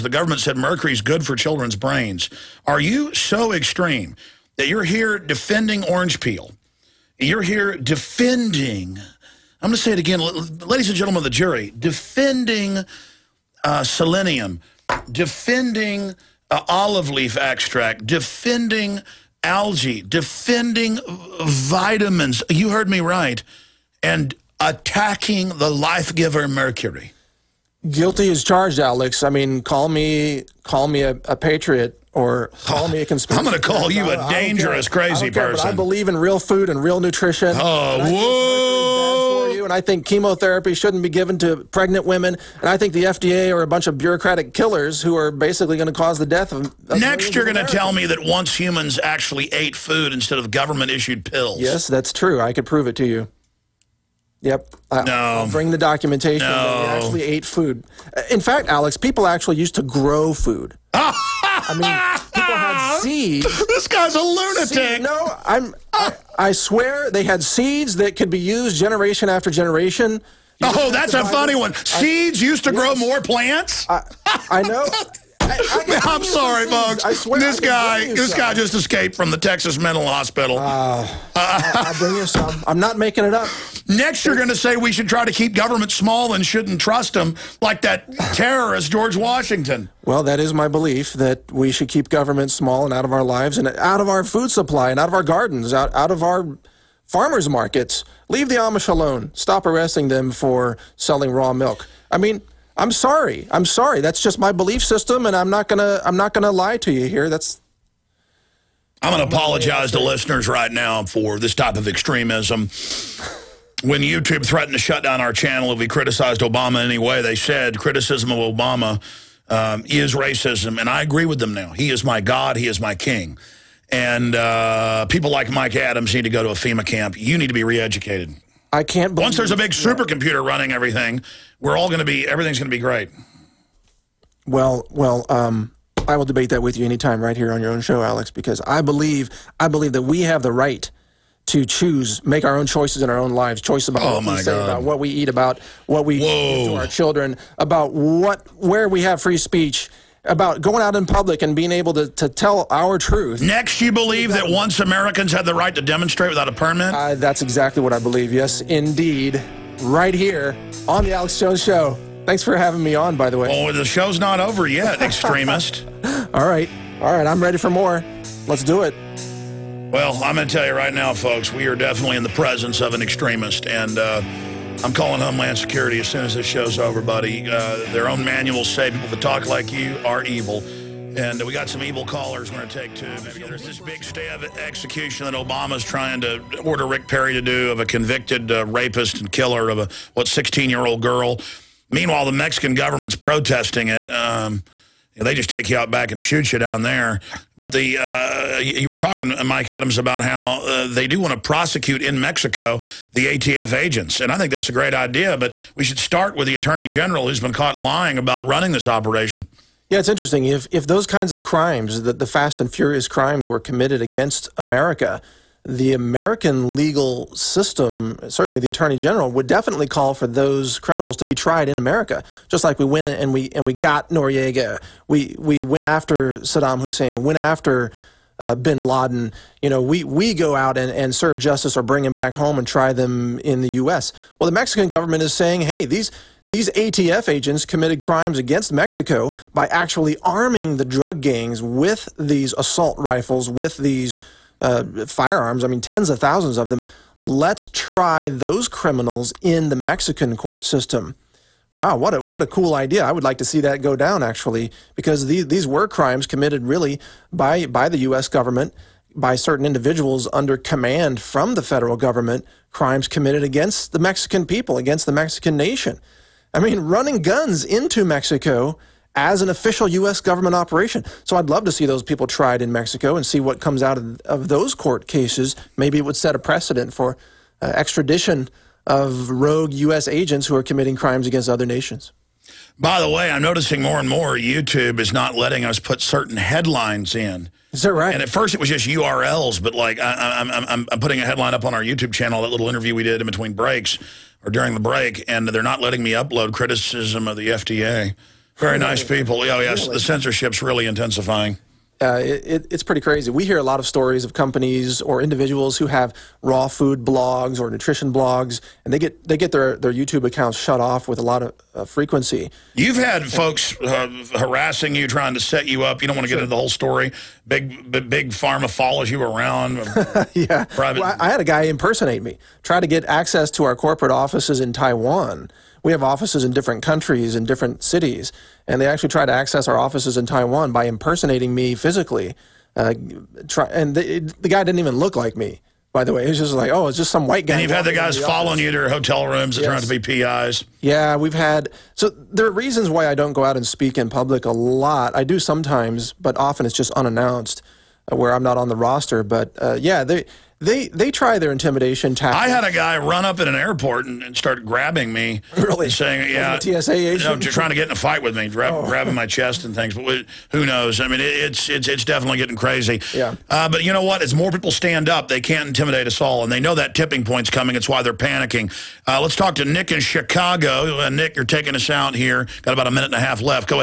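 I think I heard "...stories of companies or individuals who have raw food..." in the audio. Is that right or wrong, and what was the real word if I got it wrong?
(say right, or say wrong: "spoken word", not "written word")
right.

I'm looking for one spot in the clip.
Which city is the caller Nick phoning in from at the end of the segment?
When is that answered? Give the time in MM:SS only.
06:10.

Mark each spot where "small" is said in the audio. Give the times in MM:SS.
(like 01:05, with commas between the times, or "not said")
01:25, 01:32.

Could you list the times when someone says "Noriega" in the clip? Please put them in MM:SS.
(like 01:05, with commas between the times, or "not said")
03:44.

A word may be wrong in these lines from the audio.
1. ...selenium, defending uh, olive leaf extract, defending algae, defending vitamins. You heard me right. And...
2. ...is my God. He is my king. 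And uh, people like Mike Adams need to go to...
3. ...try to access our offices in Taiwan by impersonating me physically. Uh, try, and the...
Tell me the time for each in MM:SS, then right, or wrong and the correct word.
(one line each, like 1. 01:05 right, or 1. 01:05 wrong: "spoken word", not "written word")
1. 00:13 right
2. 02:01 right
3. 05:29 right.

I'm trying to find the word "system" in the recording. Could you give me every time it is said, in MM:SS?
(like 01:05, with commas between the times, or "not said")
01:44, 03:37, 04:10.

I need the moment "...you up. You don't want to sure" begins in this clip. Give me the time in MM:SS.
05:15.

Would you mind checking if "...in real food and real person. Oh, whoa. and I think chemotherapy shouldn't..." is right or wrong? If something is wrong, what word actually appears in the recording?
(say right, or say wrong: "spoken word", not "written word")
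wrong: "nutrition", not "person".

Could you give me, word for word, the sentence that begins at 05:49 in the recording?
But uh, yeah, they they they try their intimidation tactics.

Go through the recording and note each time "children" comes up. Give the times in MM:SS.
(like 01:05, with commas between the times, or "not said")
00:01, 02:26.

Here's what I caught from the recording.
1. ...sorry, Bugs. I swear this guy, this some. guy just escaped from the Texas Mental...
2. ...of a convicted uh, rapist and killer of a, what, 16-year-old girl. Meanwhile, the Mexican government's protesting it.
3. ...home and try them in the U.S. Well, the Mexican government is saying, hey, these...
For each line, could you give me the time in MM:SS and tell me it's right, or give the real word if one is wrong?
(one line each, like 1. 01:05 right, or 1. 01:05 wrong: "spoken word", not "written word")
1. 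01:16 right
2. 03:07 right
3. 03:52 right.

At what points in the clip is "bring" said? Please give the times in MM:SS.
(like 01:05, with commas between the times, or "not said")
00:55, 01:21, 03:51.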